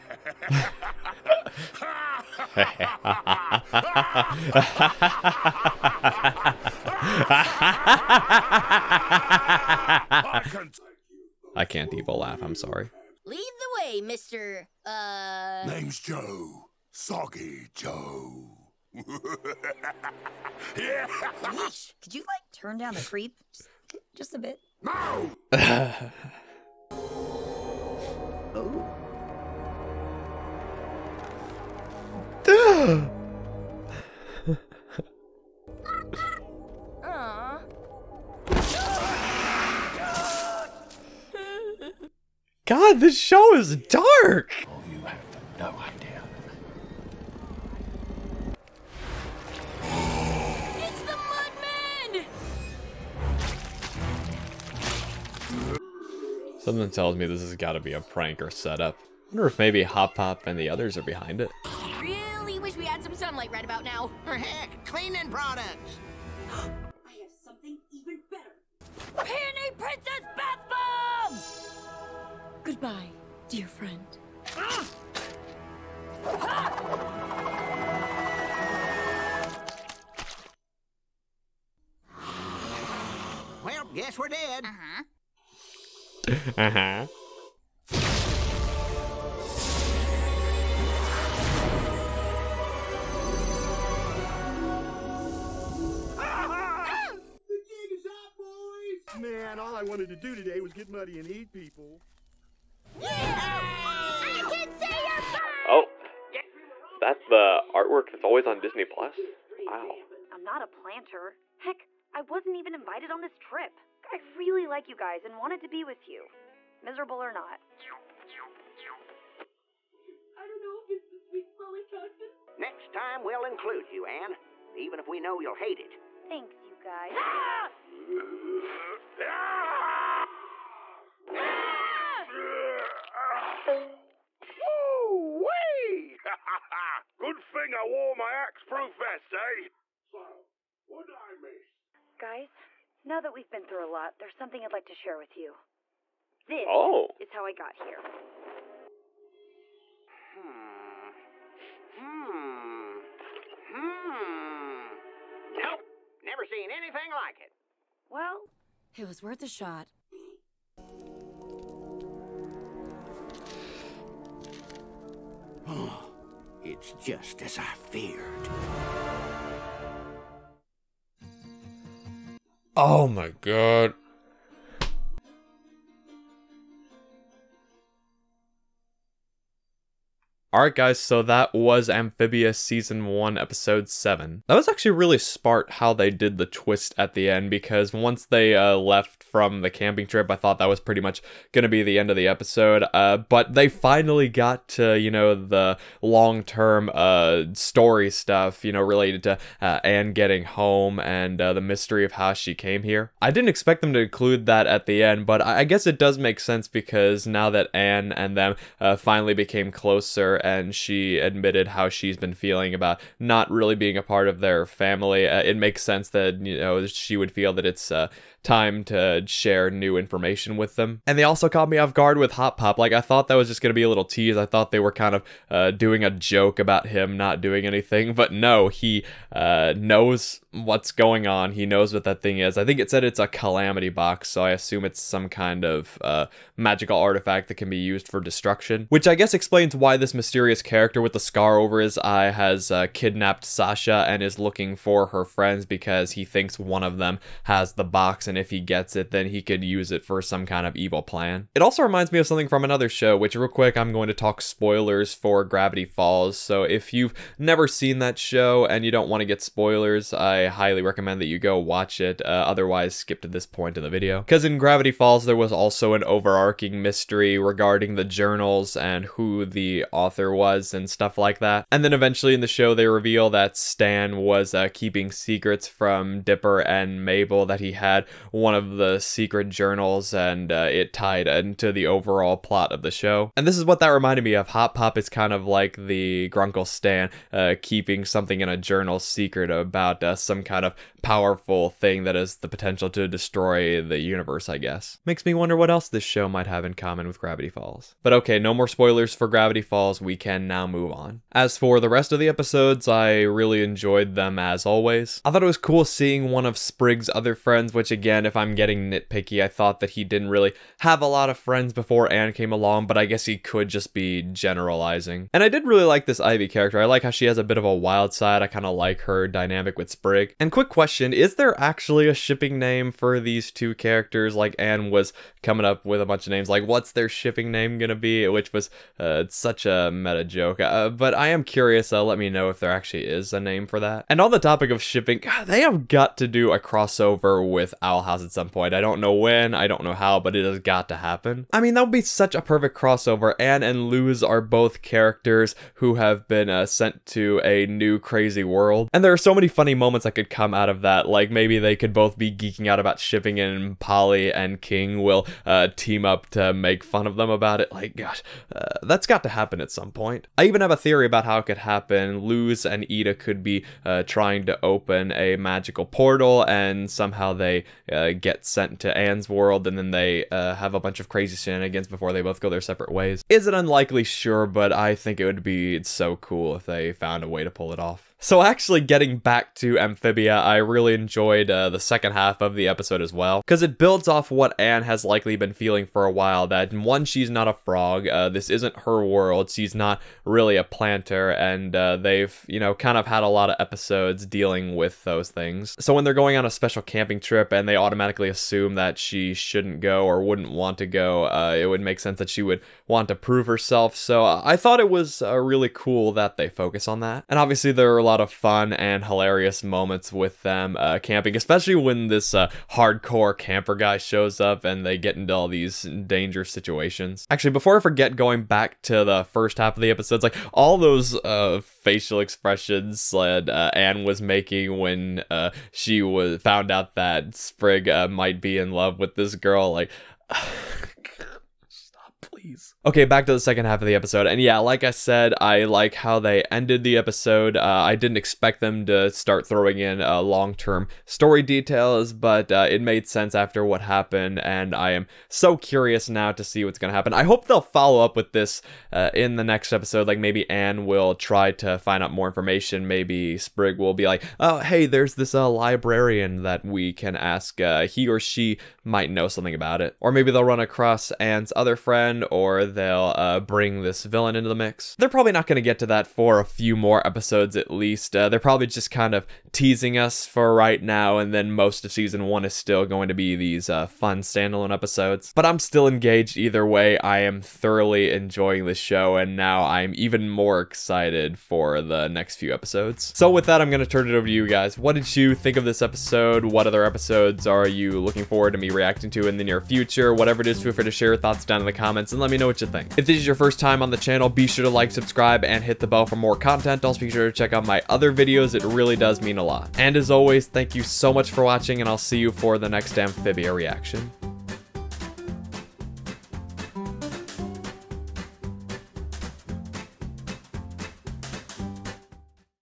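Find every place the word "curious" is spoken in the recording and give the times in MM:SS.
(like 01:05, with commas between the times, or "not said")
05:31, 07:25.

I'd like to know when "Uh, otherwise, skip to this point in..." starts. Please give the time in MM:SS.
04:22.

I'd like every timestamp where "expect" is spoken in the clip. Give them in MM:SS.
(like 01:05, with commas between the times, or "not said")
03:23, 07:18.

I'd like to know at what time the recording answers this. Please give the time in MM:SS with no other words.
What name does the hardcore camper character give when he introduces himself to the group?
00:16.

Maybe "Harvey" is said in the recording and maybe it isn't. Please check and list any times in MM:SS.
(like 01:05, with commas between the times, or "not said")
not said.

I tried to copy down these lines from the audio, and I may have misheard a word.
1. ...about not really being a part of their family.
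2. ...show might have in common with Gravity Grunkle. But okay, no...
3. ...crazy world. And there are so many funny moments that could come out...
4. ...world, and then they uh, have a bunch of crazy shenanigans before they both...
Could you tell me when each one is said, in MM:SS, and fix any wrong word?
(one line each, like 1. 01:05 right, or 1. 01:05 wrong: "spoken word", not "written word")
1. 03:32 right
2. 04:56 wrong: "Falls", not "Grunkle"
3. 05:47 right
4. 06:09 right.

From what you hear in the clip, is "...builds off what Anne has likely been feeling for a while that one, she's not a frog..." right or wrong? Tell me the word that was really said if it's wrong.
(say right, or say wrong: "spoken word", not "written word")
right.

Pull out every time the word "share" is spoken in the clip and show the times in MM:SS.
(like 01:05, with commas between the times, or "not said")
02:24, 03:39, 08:10.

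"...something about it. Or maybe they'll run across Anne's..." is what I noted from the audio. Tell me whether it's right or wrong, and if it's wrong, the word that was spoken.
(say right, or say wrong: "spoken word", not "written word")
right.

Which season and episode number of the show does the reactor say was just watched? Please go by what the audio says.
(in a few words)
Season 1, Episode 7.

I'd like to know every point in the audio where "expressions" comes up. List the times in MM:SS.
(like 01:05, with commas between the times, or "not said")
07:02.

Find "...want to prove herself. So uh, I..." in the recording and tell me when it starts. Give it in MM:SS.
06:42.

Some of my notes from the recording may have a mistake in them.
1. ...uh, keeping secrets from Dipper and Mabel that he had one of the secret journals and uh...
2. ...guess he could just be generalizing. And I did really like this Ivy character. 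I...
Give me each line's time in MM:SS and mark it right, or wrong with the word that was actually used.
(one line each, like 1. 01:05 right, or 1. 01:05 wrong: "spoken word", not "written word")
1. 04:34 right
2. 05:13 right.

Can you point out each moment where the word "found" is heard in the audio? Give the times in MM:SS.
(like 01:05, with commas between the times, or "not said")
06:16, 07:06.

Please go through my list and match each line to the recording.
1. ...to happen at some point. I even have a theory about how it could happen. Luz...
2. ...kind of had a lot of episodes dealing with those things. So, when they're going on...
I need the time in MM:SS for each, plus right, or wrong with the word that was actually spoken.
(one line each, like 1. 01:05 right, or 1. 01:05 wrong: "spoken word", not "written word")
1. 05:59 right
2. 06:32 right.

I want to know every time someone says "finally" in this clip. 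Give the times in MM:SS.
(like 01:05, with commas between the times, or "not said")
03:13, 03:28.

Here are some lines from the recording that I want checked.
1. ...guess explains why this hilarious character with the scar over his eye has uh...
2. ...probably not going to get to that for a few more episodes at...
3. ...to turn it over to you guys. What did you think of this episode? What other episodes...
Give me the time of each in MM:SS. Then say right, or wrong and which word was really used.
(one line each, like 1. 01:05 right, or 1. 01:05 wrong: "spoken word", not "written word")
1. 03:59 wrong: "mysterious", not "hilarious"
2. 07:45 right
3. 08:03 right.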